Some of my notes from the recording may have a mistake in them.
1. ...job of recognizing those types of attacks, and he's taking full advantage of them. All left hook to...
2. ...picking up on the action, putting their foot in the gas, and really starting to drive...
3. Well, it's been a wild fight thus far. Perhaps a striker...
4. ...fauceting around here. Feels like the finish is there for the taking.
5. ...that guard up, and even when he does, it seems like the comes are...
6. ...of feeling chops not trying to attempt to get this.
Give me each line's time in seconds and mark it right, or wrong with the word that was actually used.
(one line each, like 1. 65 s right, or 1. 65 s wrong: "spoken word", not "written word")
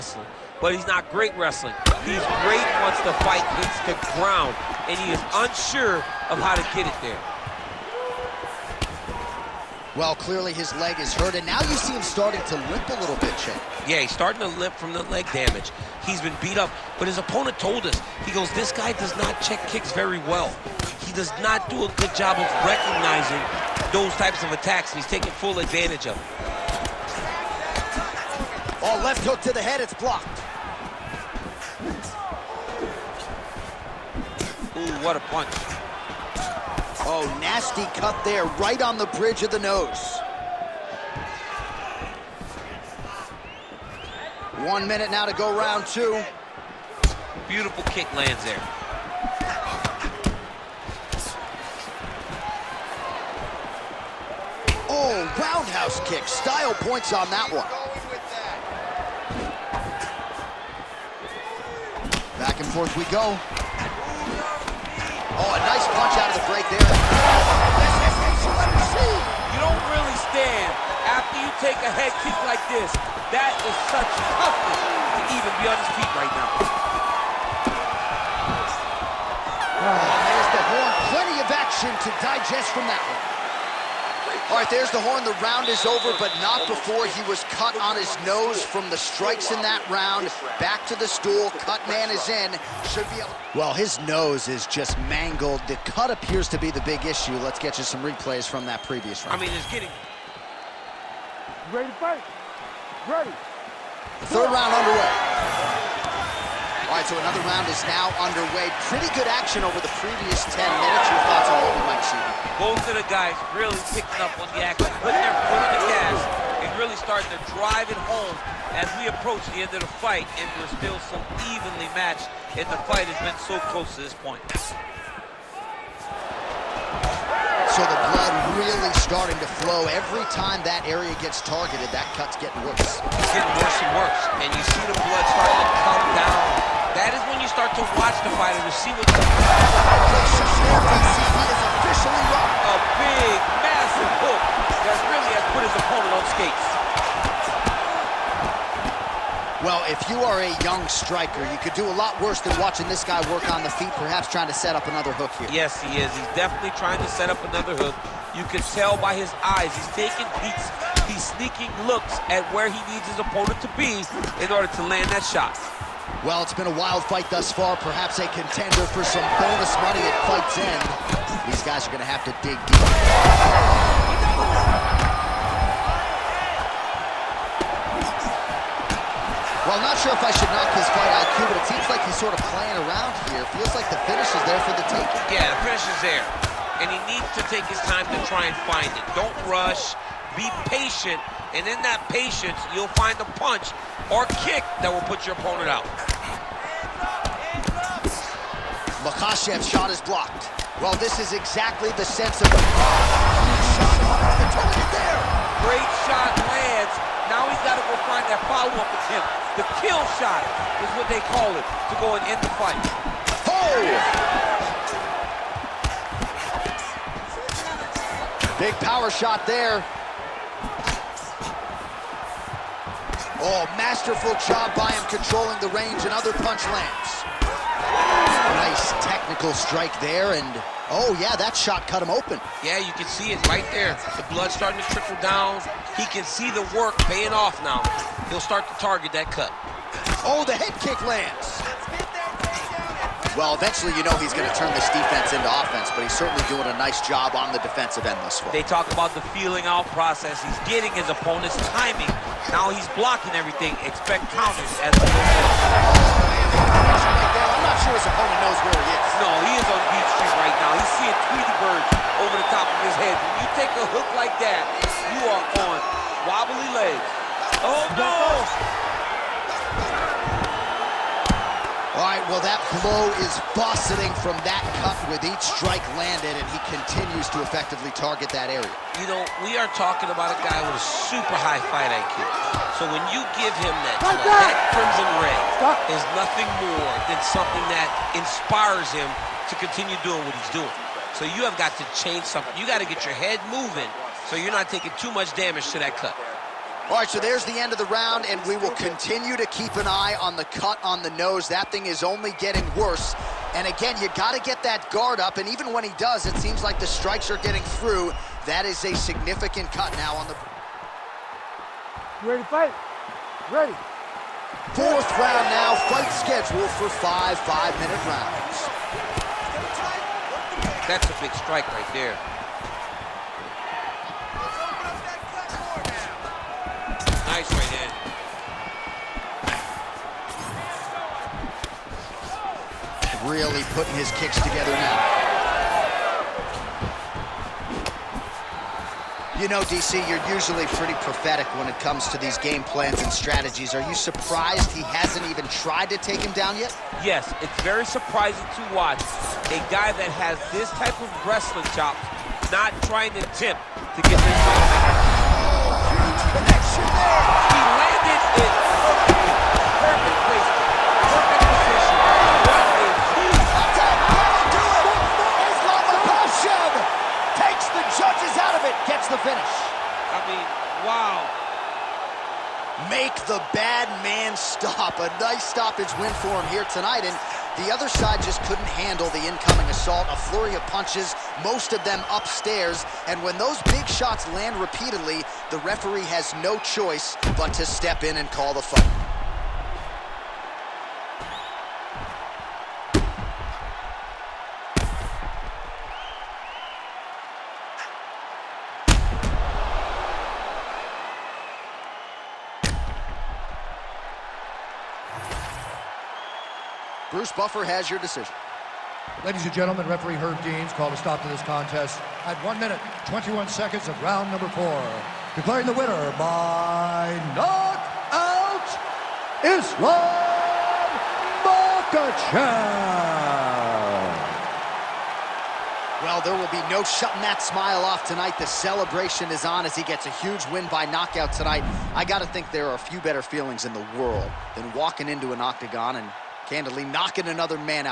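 1. 22 s right
2. 113 s right
3. 166 s wrong: "contender", not "striker"
4. 182 s wrong: "playing", not "fauceting"
5. 304 s wrong: "strikes", not "comes"
6. 351 s wrong: "wrestling", not "feeling".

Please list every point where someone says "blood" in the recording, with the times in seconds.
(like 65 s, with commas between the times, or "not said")
128 s, 134 s, 234 s.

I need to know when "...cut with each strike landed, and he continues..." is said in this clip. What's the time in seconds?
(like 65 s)
274 s.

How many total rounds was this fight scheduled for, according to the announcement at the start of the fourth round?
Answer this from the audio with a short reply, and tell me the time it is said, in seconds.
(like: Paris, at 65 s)
5, at 316 s.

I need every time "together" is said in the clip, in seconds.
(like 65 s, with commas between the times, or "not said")
334 s.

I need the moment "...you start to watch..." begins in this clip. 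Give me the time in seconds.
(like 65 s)
137 s.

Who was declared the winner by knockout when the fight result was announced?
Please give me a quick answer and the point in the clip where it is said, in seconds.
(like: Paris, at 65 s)
Islam Makhachev, at 419 s.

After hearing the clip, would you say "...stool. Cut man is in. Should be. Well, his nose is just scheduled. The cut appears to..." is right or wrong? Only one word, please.
wrong.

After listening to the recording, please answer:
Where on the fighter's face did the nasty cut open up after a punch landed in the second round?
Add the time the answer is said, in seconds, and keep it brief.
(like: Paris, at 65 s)
Bridge of the nose, at 39 s.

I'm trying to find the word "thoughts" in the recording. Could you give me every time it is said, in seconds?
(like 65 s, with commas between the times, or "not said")
111 s.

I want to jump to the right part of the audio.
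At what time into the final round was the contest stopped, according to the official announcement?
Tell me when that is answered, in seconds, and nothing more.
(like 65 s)
412 s.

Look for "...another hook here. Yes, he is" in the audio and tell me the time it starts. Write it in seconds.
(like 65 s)
154 s.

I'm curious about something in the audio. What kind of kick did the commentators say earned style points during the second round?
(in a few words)
Roundhouse kick.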